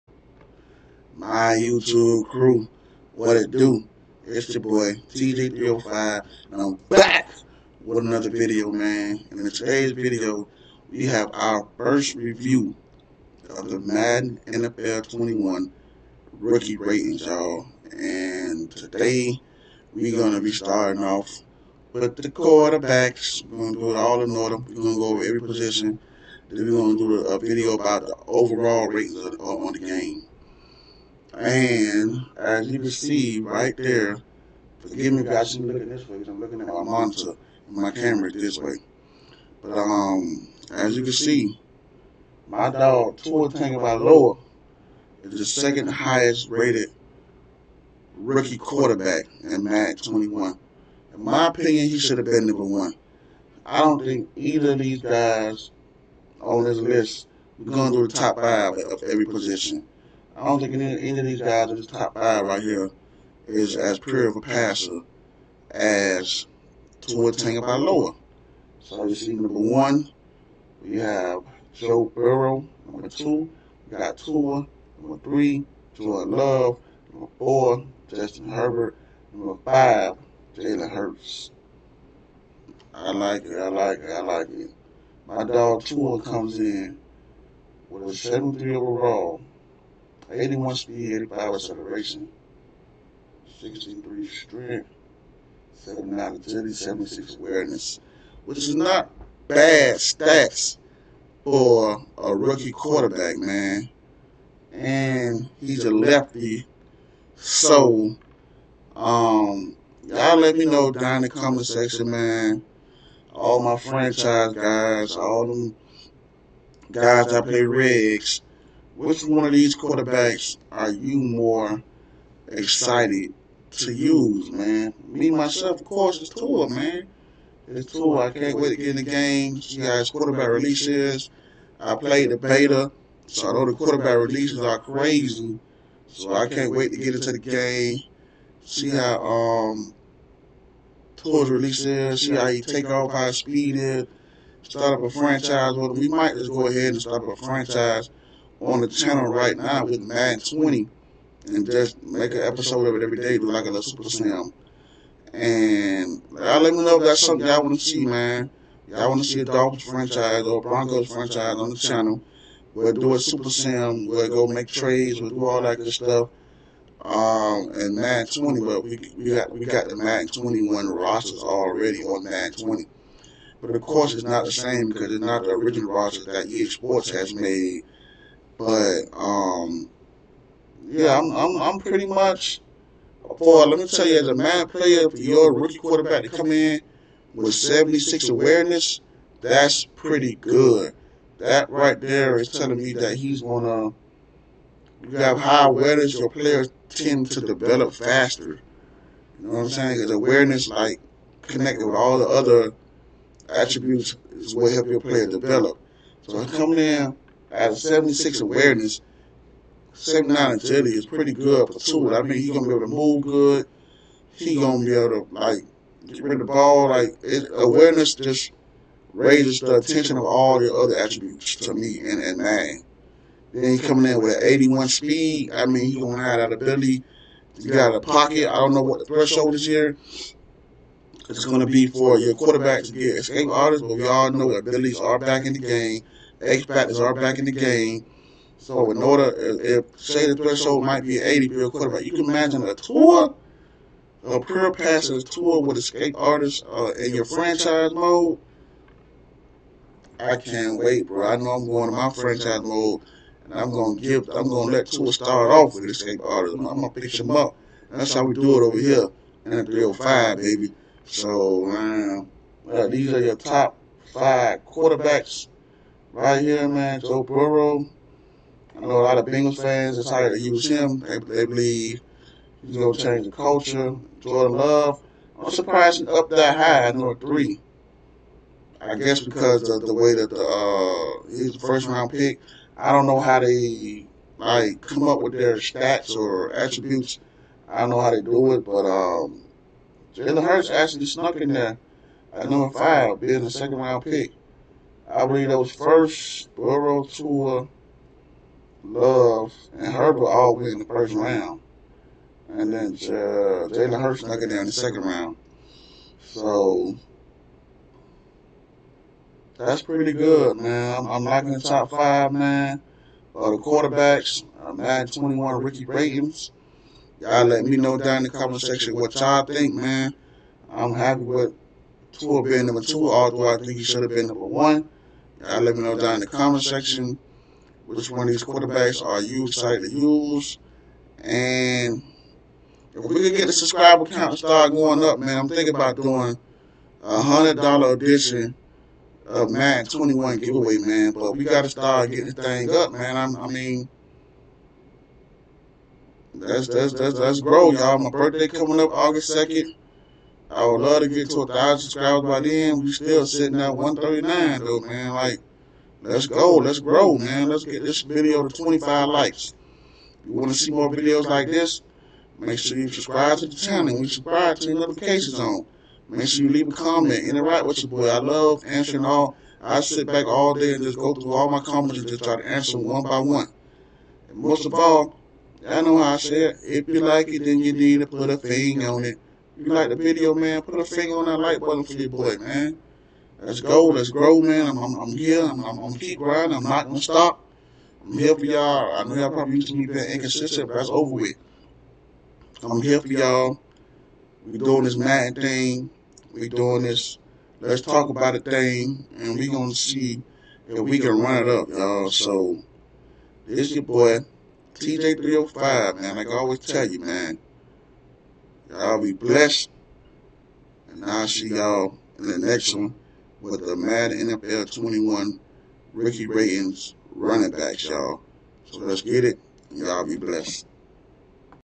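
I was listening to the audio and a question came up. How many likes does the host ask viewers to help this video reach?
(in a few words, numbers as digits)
25.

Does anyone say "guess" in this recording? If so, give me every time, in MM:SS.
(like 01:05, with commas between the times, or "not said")
04:38.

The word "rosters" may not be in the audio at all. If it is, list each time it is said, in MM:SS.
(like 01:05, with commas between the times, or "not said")
02:50, 02:55.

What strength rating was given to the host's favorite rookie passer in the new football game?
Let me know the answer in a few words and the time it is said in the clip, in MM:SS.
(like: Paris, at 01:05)
63, at 01:33.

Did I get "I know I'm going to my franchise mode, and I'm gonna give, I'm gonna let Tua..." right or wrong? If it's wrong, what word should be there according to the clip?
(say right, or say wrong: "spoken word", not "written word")
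right.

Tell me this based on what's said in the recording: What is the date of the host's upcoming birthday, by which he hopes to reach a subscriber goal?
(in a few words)
August 2.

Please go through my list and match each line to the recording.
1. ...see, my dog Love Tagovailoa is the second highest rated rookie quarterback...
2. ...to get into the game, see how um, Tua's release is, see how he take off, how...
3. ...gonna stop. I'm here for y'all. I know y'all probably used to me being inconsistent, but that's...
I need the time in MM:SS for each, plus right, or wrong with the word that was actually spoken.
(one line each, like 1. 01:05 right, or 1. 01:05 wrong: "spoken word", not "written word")
1. 00:41 wrong: "Tua", not "Love"
2. 02:16 right
3. 06:26 right.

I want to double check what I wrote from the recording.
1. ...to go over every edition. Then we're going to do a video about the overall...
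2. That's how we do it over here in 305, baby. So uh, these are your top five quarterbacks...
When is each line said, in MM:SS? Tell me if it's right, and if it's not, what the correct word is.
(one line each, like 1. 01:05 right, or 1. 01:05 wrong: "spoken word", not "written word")
1. 00:24 wrong: "position", not "edition"
2. 04:17 right.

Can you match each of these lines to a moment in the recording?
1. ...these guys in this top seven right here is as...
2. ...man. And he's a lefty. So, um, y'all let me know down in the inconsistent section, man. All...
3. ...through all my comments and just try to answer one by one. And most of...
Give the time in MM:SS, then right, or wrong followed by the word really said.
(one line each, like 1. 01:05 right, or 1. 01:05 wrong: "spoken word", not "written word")
1. 01:01 wrong: "five", not "seven"
2. 01:43 wrong: "comment", not "inconsistent"
3. 06:11 right.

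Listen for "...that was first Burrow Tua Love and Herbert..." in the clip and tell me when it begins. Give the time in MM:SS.
04:55.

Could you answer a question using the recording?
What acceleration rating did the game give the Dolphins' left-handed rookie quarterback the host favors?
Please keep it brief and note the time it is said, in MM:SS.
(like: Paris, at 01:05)
85, at 01:31.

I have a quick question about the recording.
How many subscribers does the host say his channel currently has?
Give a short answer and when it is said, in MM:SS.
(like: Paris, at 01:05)
139, at 05:53.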